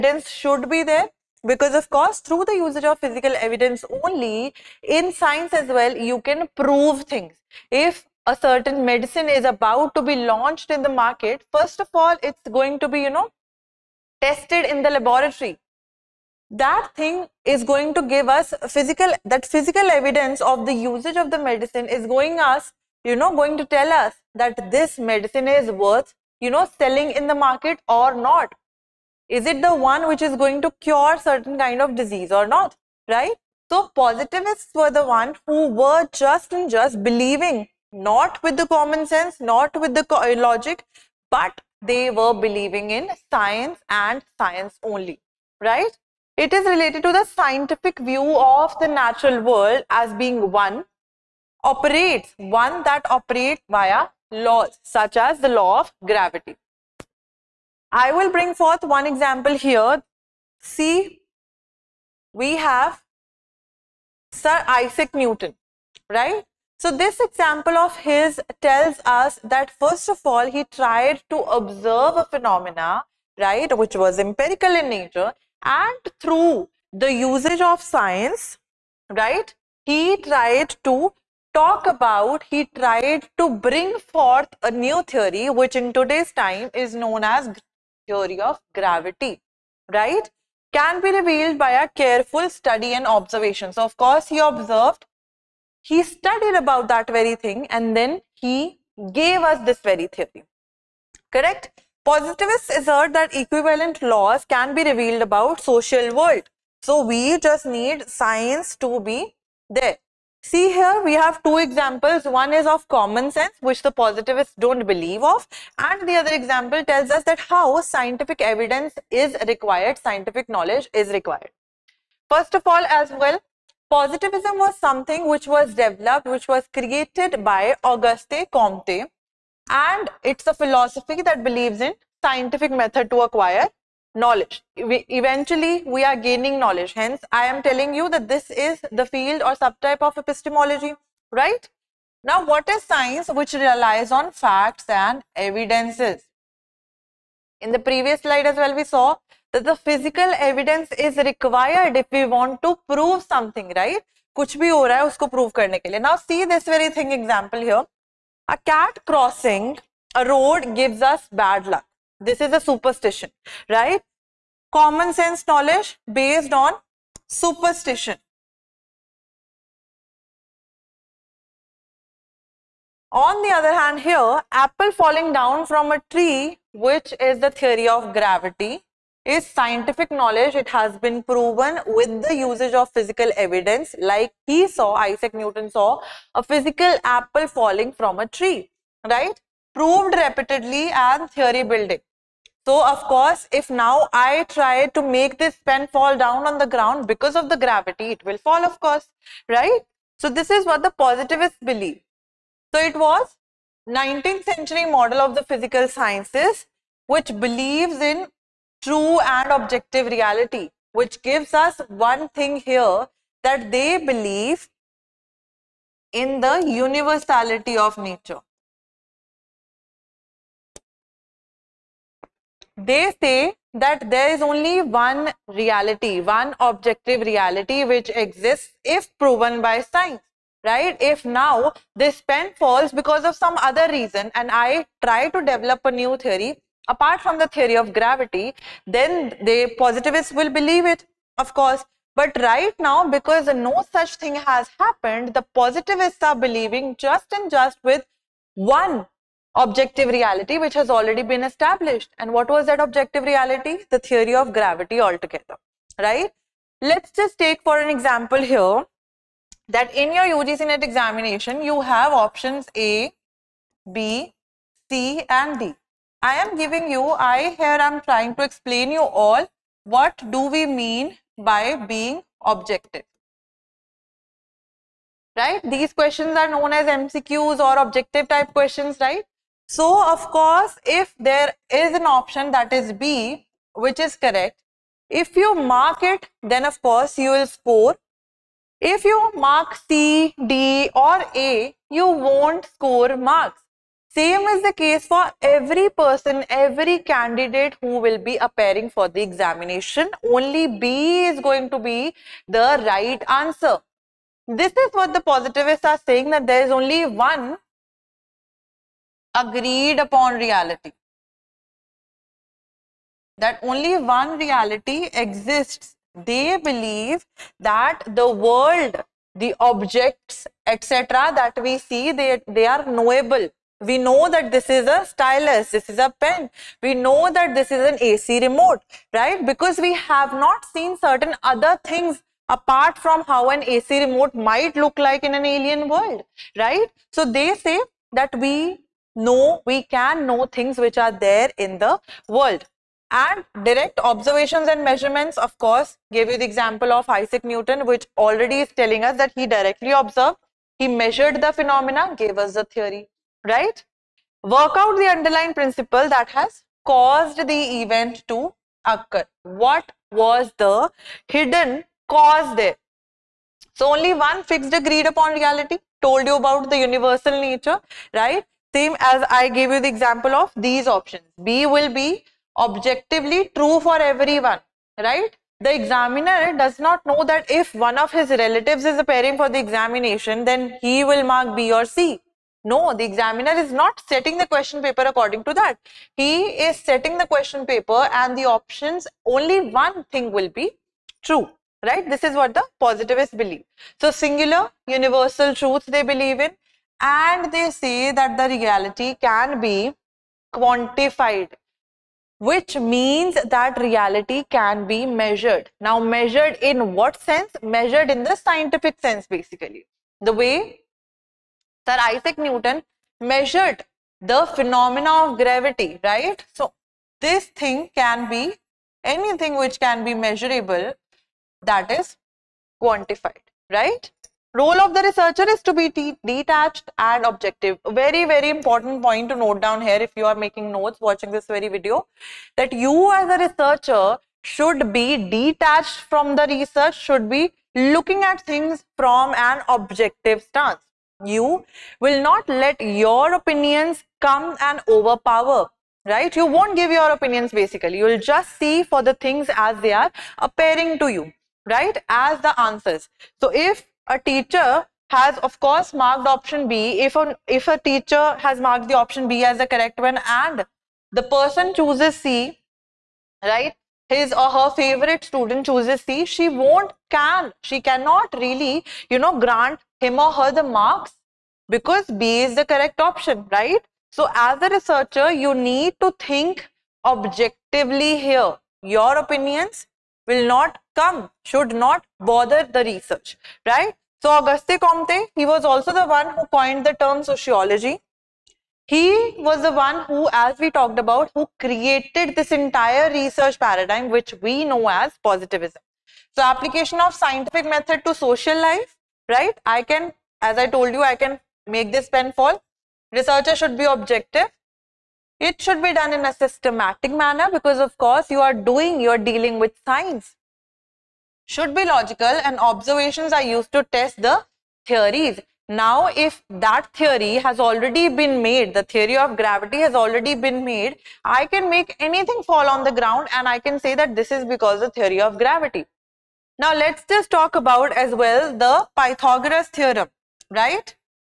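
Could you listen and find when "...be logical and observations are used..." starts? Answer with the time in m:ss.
8:31.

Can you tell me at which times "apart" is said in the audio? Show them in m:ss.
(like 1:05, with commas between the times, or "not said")
3:56, 5:32.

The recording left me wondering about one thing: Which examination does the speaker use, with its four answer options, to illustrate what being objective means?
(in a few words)
UGC NET.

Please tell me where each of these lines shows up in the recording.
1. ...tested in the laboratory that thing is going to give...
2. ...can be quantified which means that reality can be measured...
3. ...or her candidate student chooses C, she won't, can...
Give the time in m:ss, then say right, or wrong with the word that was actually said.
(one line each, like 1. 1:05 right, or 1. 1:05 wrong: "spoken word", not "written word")
1. 0:14 right
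2. 6:39 right
3. 7:44 wrong: "favorite", not "candidate".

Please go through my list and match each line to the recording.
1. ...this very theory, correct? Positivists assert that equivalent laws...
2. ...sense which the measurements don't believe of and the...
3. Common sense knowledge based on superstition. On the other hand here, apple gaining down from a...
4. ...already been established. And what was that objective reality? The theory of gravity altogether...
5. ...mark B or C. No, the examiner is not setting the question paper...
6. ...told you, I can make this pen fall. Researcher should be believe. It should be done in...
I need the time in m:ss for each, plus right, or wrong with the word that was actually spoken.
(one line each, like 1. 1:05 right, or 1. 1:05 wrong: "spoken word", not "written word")
1. 1:39 right
2. 1:53 wrong: "positivists", not "measurements"
3. 2:44 wrong: "falling", not "gaining"
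4. 4:10 right
5. 6:21 right
6. 8:20 wrong: "objective", not "believe".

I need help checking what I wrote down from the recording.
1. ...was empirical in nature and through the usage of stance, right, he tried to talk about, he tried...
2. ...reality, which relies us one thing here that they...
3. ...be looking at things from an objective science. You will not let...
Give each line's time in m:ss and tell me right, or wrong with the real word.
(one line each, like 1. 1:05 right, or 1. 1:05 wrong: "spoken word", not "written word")
1. 1:13 wrong: "science", not "stance"
2. 3:30 wrong: "gives", not "relies"
3. 7:17 wrong: "stance", not "science".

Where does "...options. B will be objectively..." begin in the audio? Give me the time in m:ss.
6:10.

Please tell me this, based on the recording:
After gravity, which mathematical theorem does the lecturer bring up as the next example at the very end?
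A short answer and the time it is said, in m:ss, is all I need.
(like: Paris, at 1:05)
Pythagoras theorem, at 8:48.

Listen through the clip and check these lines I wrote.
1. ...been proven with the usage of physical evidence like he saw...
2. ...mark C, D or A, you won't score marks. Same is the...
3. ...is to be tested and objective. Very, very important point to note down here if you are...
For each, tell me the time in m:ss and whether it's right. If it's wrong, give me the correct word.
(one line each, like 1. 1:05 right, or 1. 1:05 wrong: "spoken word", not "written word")
1. 3:00 right
2. 4:49 right
3. 7:05 wrong: "detached", not "tested".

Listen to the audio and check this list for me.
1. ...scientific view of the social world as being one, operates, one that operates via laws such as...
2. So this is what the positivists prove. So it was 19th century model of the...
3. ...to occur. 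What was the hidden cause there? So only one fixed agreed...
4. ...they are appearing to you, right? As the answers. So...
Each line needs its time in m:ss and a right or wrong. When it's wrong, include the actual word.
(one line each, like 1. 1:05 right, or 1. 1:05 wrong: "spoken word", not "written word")
1. 0:47 wrong: "natural", not "social"
2. 3:20 wrong: "believe", not "prove"
3. 5:58 right
4. 7:29 right.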